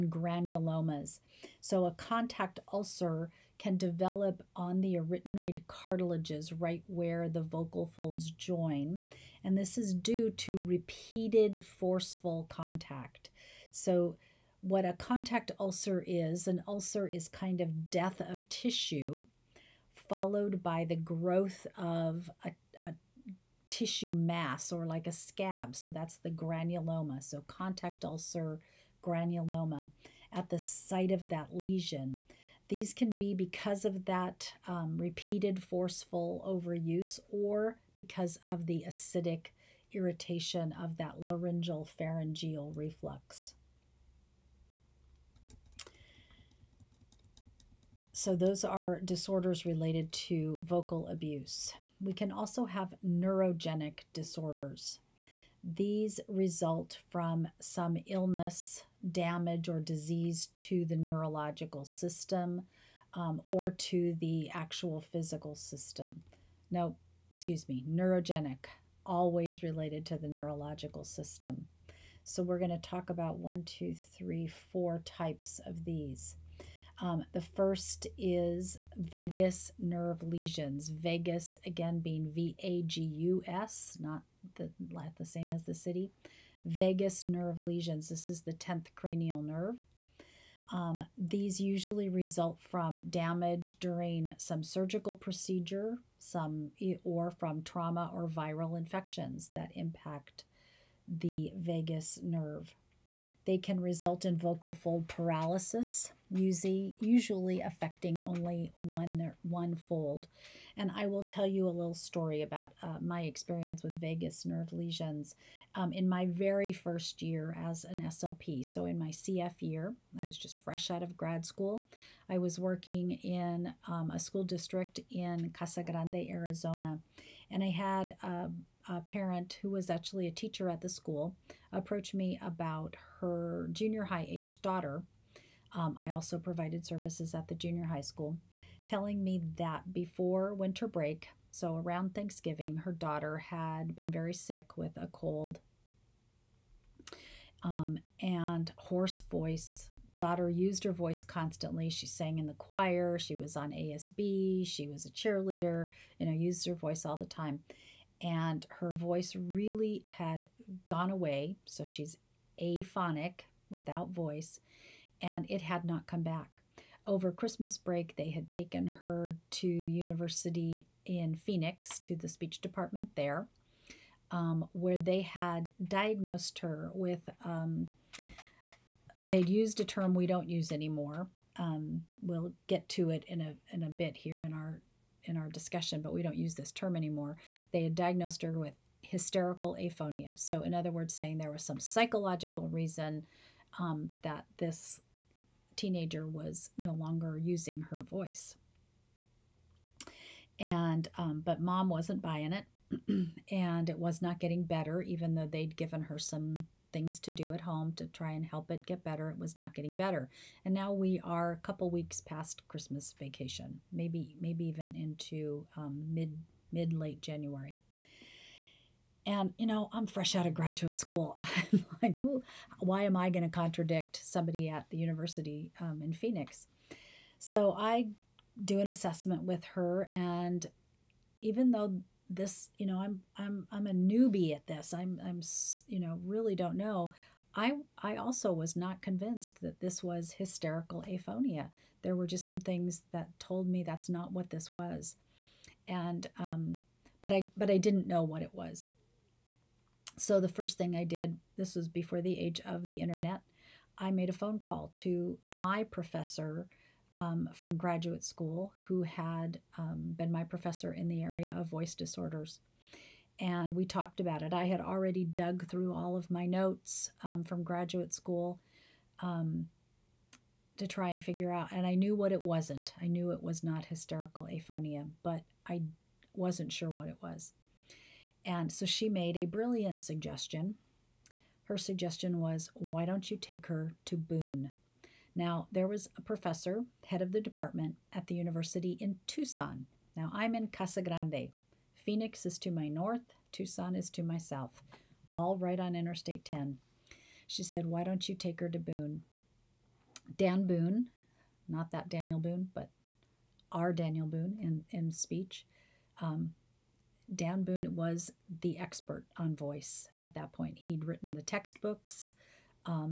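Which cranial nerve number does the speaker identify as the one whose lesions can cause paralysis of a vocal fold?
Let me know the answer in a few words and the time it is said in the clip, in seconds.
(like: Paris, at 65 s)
10th, at 88 s.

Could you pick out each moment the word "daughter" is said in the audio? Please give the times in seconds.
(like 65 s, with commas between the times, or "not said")
134 s, 142 s, 150 s.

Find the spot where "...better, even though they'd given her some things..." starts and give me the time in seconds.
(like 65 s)
204 s.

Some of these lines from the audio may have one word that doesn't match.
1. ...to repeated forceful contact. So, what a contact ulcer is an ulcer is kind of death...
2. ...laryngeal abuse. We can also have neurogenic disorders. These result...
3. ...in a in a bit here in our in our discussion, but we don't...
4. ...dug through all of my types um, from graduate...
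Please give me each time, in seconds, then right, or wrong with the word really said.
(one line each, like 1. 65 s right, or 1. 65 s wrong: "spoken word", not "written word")
1. 10 s right
2. 50 s wrong: "vocal", not "laryngeal"
3. 183 s right
4. 265 s wrong: "notes", not "types".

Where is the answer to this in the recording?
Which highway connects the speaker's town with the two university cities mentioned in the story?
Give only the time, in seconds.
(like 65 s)
295 s.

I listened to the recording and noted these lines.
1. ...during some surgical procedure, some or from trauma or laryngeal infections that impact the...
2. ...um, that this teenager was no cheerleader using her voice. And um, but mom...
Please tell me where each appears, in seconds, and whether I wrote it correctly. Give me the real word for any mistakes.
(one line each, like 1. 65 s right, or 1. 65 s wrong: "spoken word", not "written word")
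1. 93 s wrong: "viral", not "laryngeal"
2. 193 s wrong: "longer", not "cheerleader".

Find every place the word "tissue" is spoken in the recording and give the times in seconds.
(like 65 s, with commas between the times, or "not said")
18 s, 23 s.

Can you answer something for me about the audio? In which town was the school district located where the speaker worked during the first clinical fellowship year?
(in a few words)
Casa Grande, Arizona.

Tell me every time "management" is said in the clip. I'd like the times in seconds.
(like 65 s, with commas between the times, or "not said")
not said.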